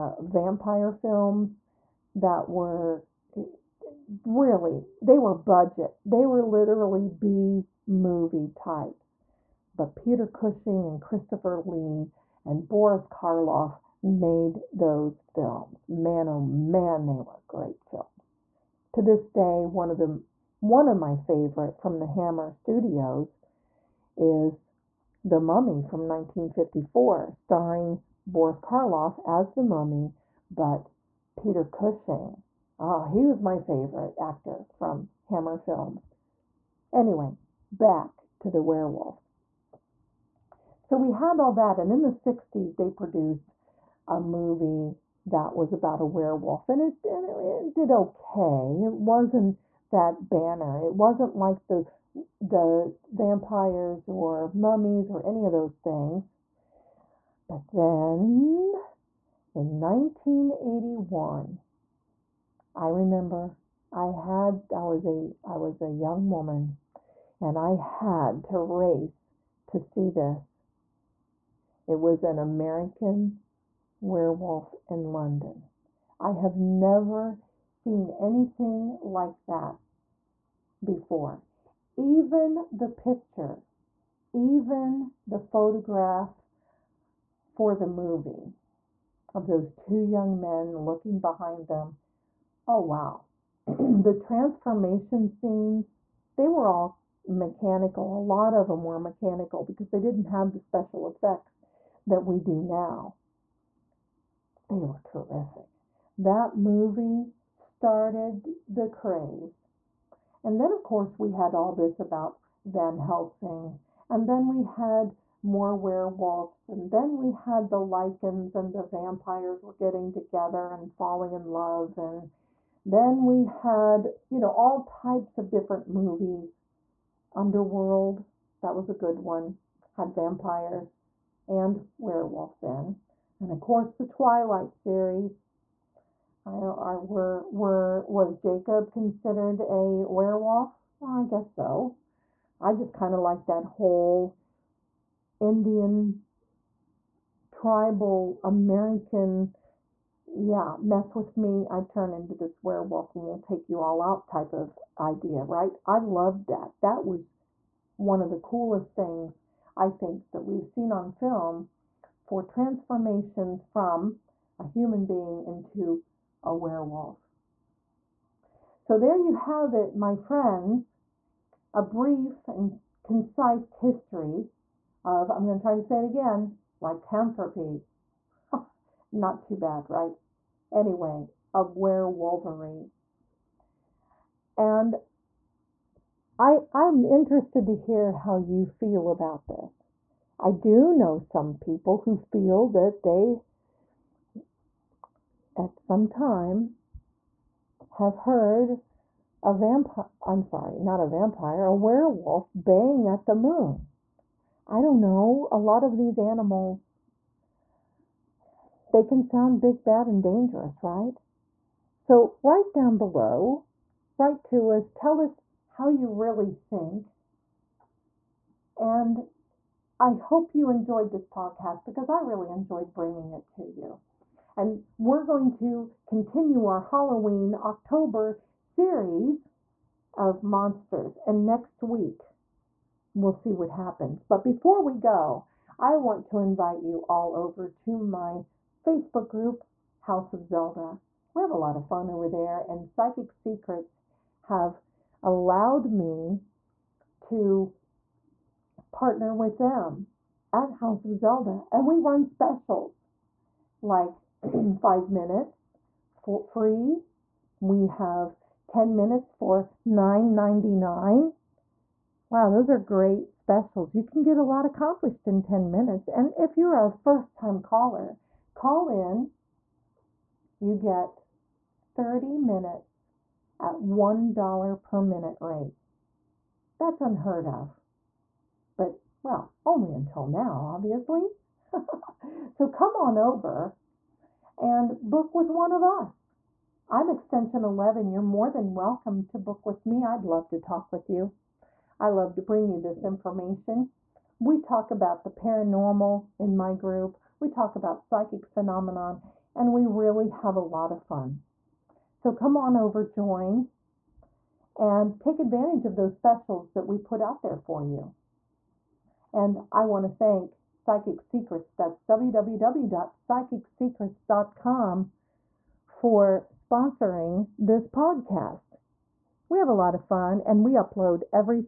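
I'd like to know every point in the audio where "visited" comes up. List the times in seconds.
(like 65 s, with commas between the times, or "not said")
not said.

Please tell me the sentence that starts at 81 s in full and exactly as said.
Even the picture, even the photograph for the movie of those two young men looking behind them.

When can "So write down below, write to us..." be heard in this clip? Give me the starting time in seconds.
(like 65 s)
211 s.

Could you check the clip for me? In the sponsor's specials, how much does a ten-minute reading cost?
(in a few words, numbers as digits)
$9.99.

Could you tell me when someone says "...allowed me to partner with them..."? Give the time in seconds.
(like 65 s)
245 s.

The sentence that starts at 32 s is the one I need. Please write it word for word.
Oh, he was my favorite actor from Hammer Films.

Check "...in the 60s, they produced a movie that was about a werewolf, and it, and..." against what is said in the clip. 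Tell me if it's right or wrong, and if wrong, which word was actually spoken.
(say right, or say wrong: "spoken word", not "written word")
right.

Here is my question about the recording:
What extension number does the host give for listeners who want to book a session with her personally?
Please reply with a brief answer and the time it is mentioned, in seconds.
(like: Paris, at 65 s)
11, at 287 s.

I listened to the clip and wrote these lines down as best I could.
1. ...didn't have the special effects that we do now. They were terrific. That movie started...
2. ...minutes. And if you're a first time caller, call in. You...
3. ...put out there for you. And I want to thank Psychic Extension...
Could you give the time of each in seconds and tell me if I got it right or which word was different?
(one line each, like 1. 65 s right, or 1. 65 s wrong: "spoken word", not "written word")
1. 99 s right
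2. 265 s right
3. 306 s wrong: "Secrets", not "Extension".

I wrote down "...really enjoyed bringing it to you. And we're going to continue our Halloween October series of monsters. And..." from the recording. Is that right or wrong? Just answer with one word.
right.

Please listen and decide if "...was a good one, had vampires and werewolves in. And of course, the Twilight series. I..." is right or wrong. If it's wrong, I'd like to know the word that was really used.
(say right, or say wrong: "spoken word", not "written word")
right.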